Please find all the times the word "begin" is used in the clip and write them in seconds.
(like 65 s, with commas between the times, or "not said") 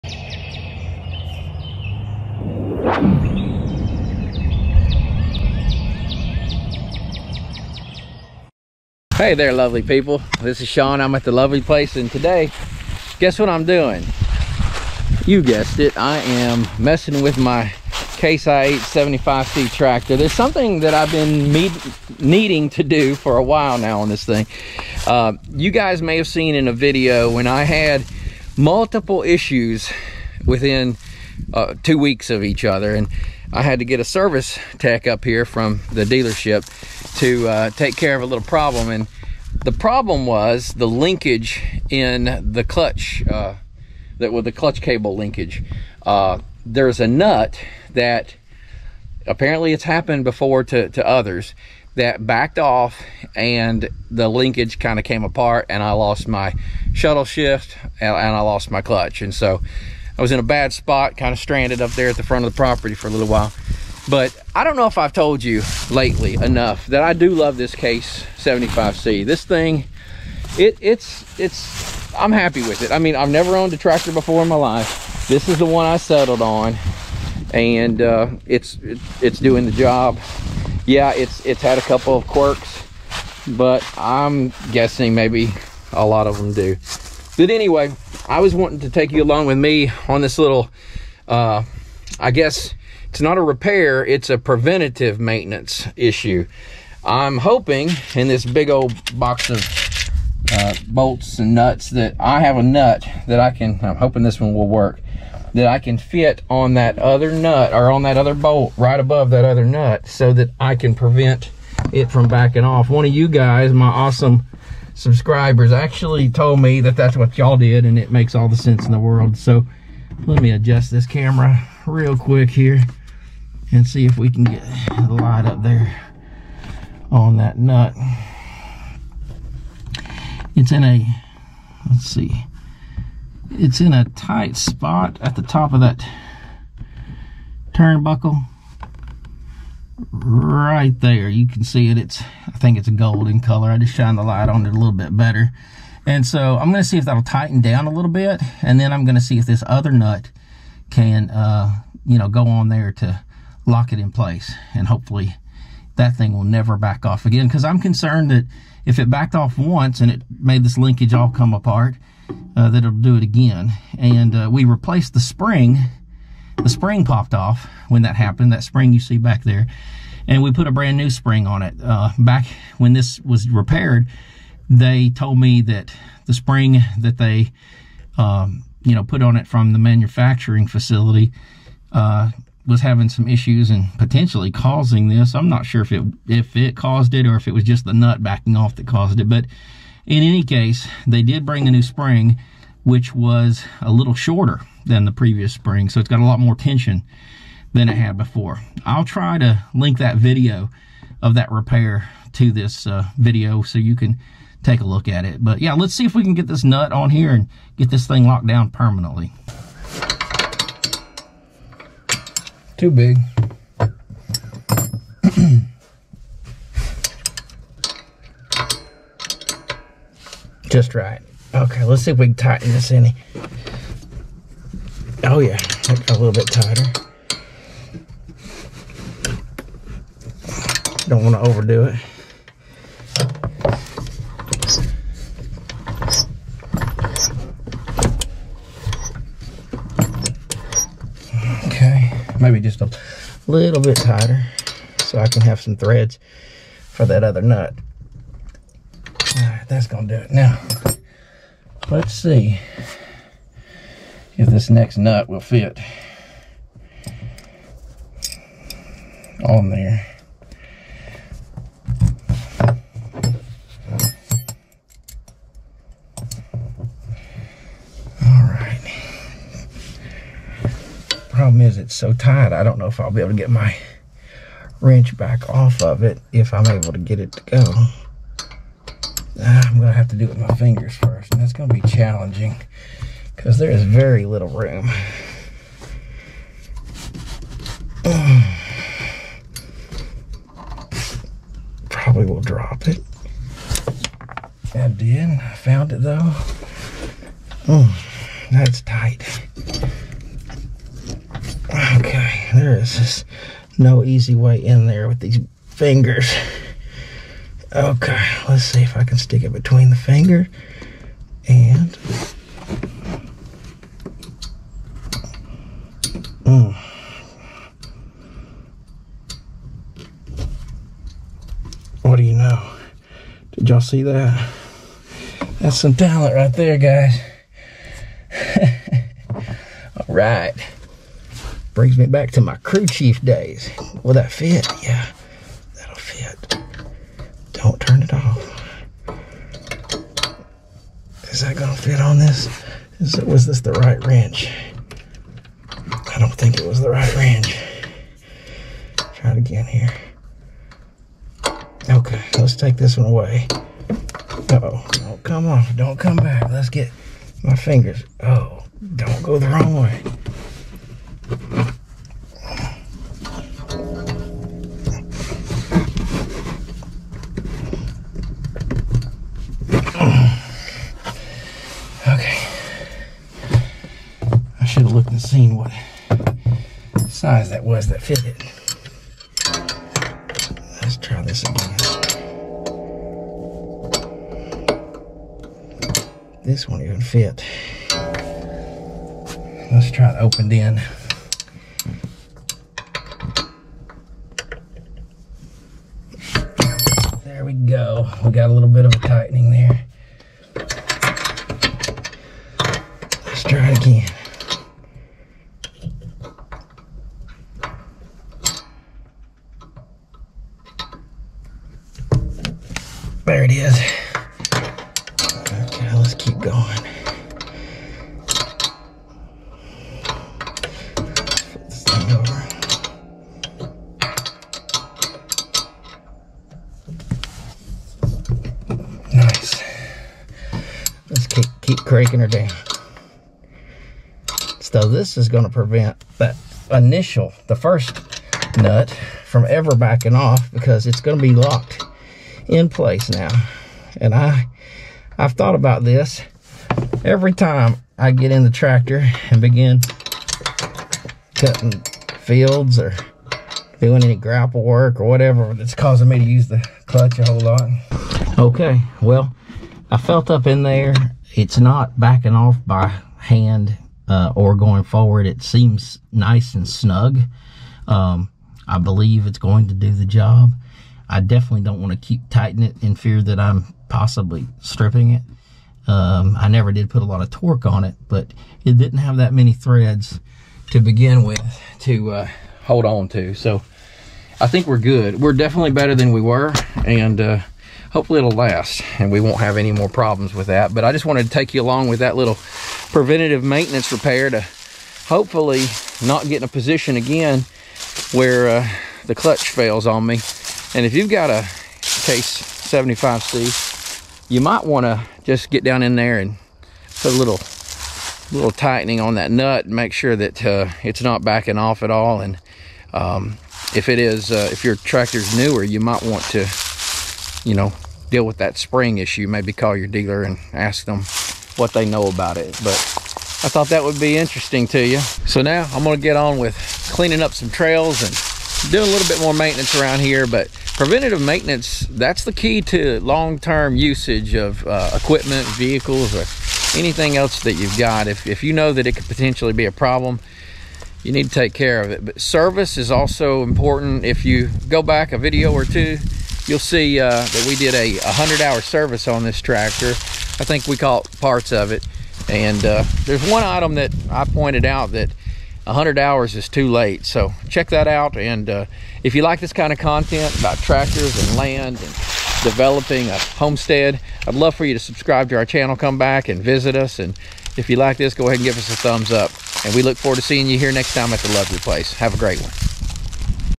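449 s, 480 s.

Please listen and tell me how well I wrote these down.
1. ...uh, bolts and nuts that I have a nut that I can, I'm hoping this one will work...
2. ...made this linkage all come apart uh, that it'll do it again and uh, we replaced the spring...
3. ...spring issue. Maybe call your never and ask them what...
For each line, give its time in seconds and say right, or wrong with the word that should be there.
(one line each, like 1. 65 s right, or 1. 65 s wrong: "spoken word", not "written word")
1. 100 s right
2. 160 s right
3. 518 s wrong: "dealer", not "never".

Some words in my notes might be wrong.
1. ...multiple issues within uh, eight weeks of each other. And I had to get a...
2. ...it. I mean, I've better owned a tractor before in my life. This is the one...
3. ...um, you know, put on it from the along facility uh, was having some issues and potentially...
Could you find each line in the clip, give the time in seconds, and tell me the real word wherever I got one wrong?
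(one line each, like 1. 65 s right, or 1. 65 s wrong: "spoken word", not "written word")
1. 28 s wrong: "two", not "eight"
2. 72 s wrong: "never", not "better"
3. 178 s wrong: "manufacturing", not "along".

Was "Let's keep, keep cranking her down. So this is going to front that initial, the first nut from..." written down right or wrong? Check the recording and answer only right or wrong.
wrong.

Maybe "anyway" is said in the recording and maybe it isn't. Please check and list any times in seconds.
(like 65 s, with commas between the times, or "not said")
87 s.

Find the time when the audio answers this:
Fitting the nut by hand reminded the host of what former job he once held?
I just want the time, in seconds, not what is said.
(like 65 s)
332 s.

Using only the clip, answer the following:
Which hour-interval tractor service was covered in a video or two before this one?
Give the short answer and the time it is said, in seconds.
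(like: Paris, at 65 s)
100 hour, at 548 s.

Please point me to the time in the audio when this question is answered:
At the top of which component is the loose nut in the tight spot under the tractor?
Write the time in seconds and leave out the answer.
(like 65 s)
137 s.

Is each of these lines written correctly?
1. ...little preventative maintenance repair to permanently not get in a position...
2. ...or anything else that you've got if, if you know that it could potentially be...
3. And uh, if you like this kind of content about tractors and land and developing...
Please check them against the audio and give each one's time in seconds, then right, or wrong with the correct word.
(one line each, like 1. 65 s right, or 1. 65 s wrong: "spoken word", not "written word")
1. 492 s wrong: "hopefully", not "permanently"
2. 536 s right
3. 558 s right.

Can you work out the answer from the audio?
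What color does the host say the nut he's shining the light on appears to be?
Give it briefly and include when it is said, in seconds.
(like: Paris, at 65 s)
Golden, at 142 s.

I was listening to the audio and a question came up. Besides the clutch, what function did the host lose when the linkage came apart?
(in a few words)
Shuttle shift.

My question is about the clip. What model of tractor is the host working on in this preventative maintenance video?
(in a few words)
Case IH 75C.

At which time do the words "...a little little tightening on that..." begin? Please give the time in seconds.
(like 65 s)
507 s.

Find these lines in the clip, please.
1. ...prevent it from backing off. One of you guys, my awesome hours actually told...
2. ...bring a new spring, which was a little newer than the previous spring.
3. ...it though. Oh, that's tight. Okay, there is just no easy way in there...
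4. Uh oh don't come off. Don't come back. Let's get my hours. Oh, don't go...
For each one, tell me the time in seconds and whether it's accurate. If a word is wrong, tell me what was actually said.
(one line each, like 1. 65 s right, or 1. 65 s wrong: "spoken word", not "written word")
1. 110 s wrong: "subscribers", not "hours"
2. 191 s wrong: "shorter", not "newer"
3. 295 s right
4. 353 s wrong: "fingers", not "hours".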